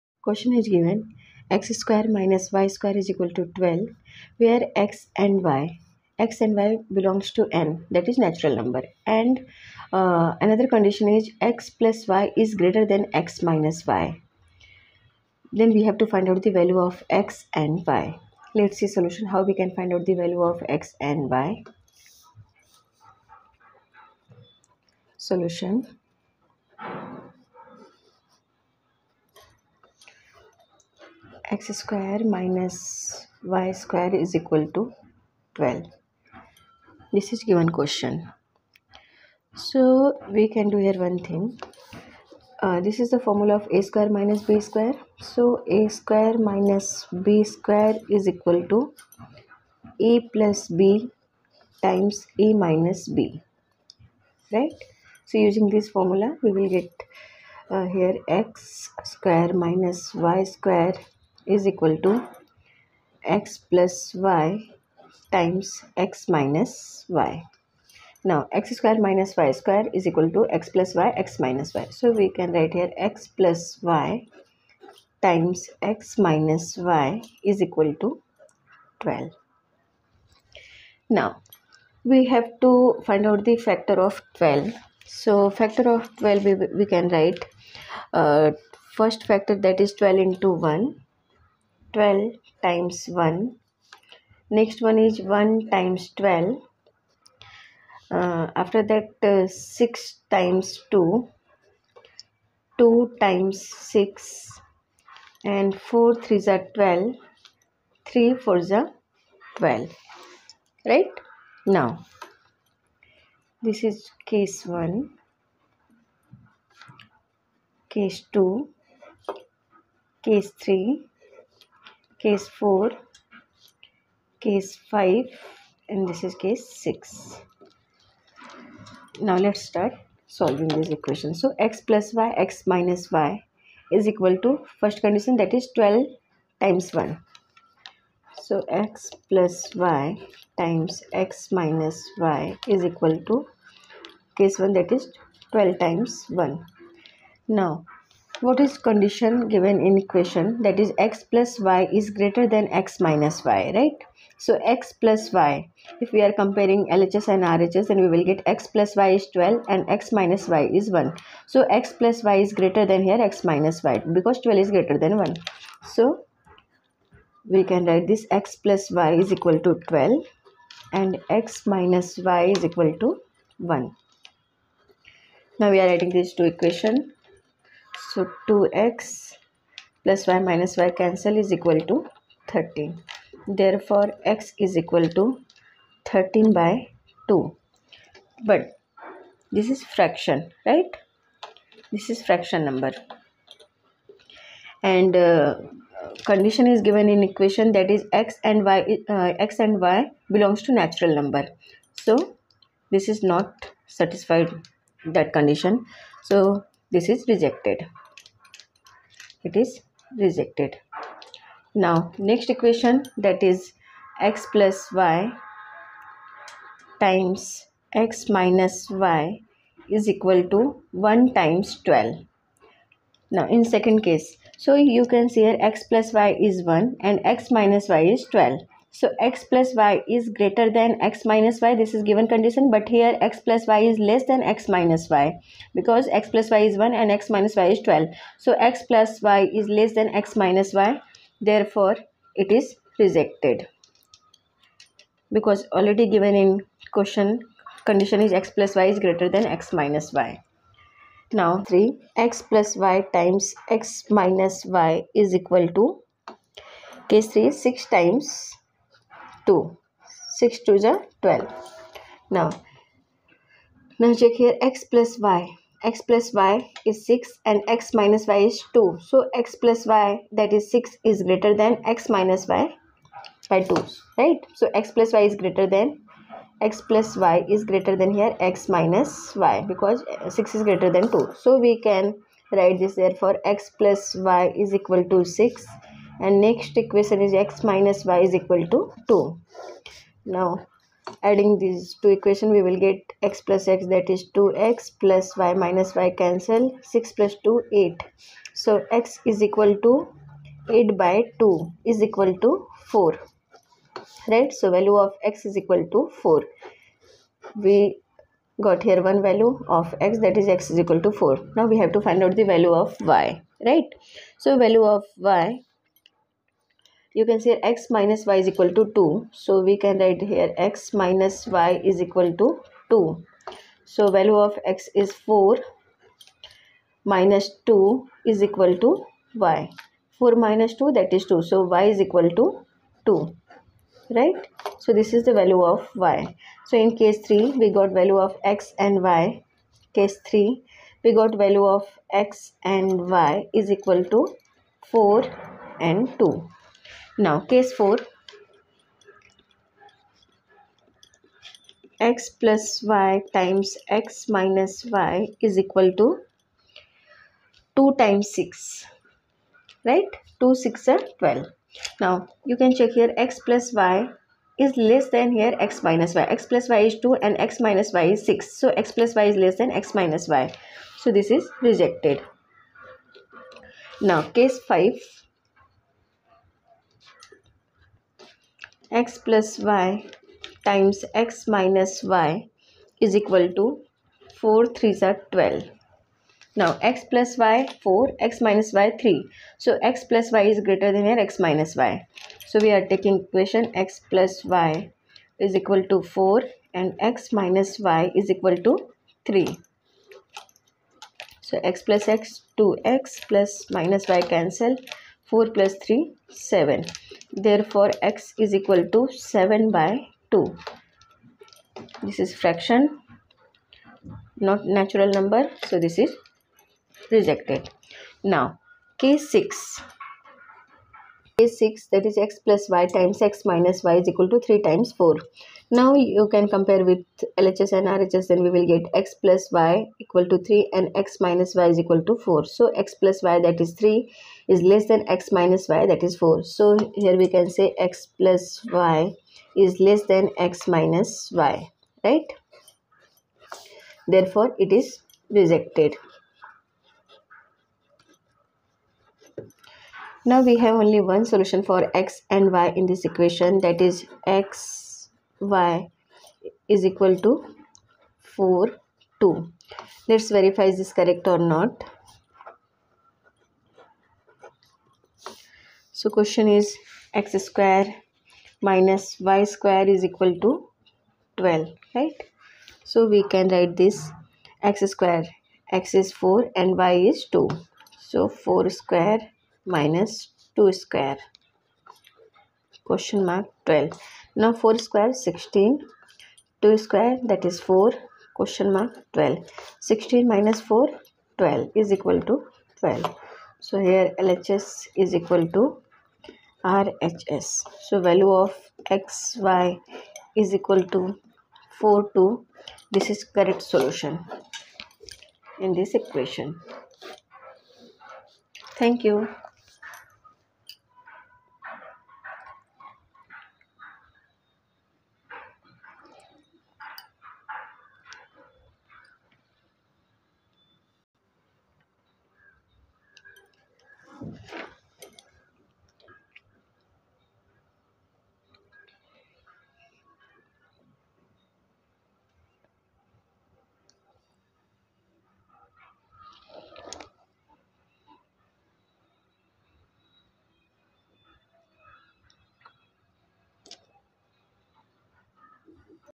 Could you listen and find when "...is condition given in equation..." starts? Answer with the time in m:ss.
2:28.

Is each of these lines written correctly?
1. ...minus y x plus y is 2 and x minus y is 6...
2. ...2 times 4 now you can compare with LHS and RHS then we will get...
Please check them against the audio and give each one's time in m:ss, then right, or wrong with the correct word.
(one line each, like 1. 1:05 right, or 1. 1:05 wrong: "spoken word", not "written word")
1. 6:05 right
2. 7:04 wrong: "3", not "2".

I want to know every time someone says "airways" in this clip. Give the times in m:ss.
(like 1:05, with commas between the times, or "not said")
not said.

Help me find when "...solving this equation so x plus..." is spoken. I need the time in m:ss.
2:10.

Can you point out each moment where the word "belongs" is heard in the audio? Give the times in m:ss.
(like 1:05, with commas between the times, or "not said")
0:06, 3:20.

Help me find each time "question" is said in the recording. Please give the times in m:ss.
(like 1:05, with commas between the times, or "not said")
0:00, 0:37, 4:06, 7:46, 8:02, 8:08.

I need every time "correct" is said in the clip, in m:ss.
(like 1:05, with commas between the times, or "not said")
7:41, 8:23.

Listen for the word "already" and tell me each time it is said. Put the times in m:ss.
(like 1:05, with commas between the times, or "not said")
4:05.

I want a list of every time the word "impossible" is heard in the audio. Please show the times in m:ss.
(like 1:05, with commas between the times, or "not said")
not said.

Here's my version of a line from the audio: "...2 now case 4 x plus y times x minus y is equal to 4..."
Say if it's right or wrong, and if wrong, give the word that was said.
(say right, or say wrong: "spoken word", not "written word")
wrong: "2", not "4".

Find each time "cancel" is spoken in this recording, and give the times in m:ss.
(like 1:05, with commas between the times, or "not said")
3:00, 4:56, 6:44.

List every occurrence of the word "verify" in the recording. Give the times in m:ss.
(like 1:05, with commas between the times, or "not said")
7:40.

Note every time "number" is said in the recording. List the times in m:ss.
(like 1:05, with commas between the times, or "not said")
0:08, 3:12, 3:21, 6:55.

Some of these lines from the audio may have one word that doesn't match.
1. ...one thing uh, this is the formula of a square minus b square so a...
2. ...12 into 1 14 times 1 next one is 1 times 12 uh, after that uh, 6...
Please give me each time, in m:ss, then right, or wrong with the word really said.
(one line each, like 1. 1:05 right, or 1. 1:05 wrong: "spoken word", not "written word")
1. 0:41 right
2. 1:29 wrong: "12", not "14".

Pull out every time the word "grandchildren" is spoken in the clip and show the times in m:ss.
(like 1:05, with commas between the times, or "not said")
not said.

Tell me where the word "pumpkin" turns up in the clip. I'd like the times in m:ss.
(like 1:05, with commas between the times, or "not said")
not said.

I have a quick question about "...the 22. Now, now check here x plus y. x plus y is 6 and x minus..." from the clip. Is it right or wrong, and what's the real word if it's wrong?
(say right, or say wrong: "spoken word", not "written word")
wrong: "12", not "22".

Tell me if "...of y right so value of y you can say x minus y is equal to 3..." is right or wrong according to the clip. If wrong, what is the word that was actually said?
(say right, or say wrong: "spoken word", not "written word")
wrong: "2", not "3".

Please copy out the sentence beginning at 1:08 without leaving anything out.
Now x square minus y square is equal to x plus y x minus y.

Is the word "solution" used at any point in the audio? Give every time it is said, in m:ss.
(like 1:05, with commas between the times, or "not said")
0:18, 0:25, 7:31, 8:23.